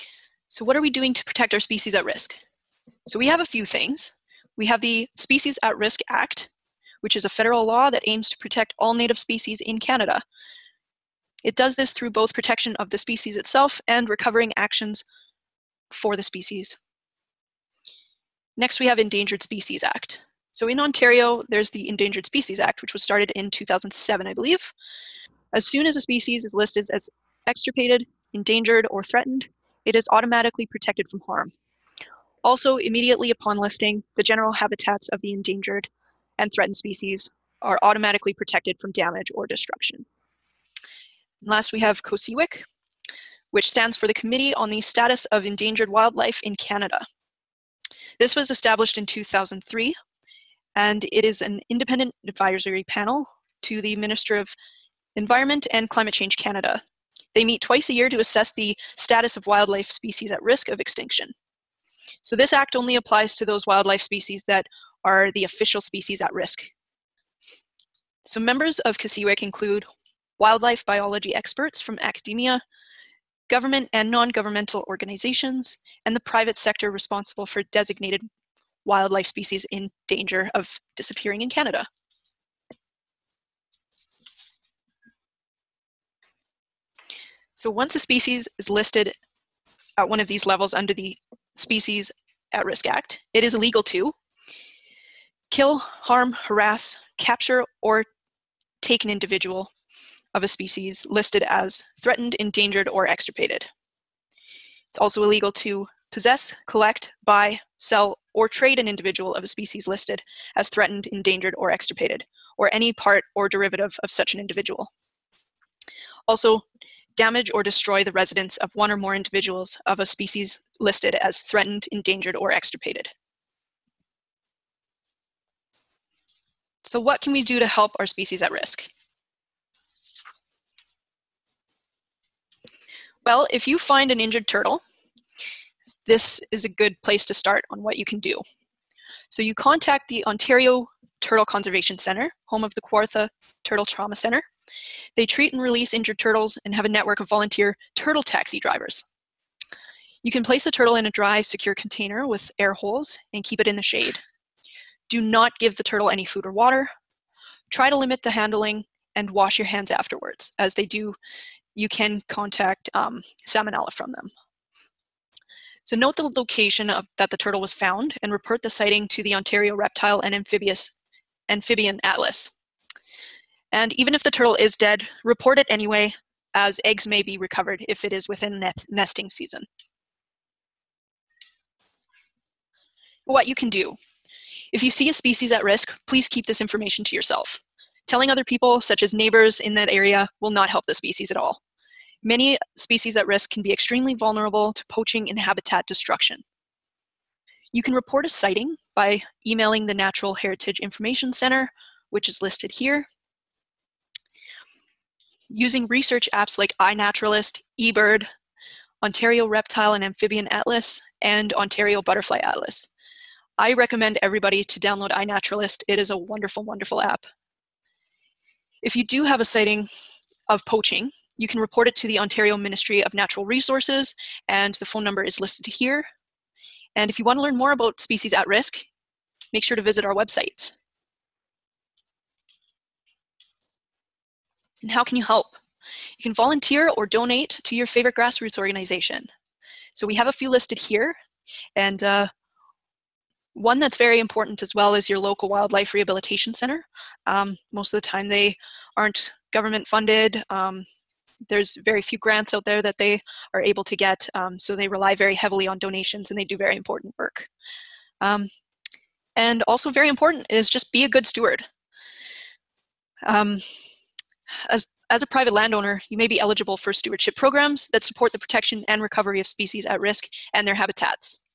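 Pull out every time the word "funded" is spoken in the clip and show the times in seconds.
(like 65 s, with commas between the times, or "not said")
249 s.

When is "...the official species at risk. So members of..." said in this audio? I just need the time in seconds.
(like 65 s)
65 s.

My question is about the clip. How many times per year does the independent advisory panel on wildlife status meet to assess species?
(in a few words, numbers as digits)
Twice.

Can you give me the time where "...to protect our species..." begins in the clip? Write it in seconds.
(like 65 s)
1 s.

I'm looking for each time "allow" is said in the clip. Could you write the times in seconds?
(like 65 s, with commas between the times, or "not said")
not said.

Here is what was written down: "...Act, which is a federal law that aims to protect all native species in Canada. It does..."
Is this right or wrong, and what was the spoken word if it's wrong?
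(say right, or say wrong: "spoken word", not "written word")
right.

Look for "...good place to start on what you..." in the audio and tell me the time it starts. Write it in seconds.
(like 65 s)
136 s.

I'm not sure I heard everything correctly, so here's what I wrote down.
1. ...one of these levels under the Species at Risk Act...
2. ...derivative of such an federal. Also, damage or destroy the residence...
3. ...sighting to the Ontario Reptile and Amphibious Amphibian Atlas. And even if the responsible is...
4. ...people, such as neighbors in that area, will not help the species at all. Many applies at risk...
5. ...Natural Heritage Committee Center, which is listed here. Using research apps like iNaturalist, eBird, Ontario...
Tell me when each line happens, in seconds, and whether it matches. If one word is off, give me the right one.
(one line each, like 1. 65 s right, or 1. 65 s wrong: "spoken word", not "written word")
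1. 90 s right
2. 113 s wrong: "individual", not "federal"
3. 168 s wrong: "turtle", not "responsible"
4. 188 s wrong: "species", not "applies"
5. 199 s wrong: "Information", not "Committee".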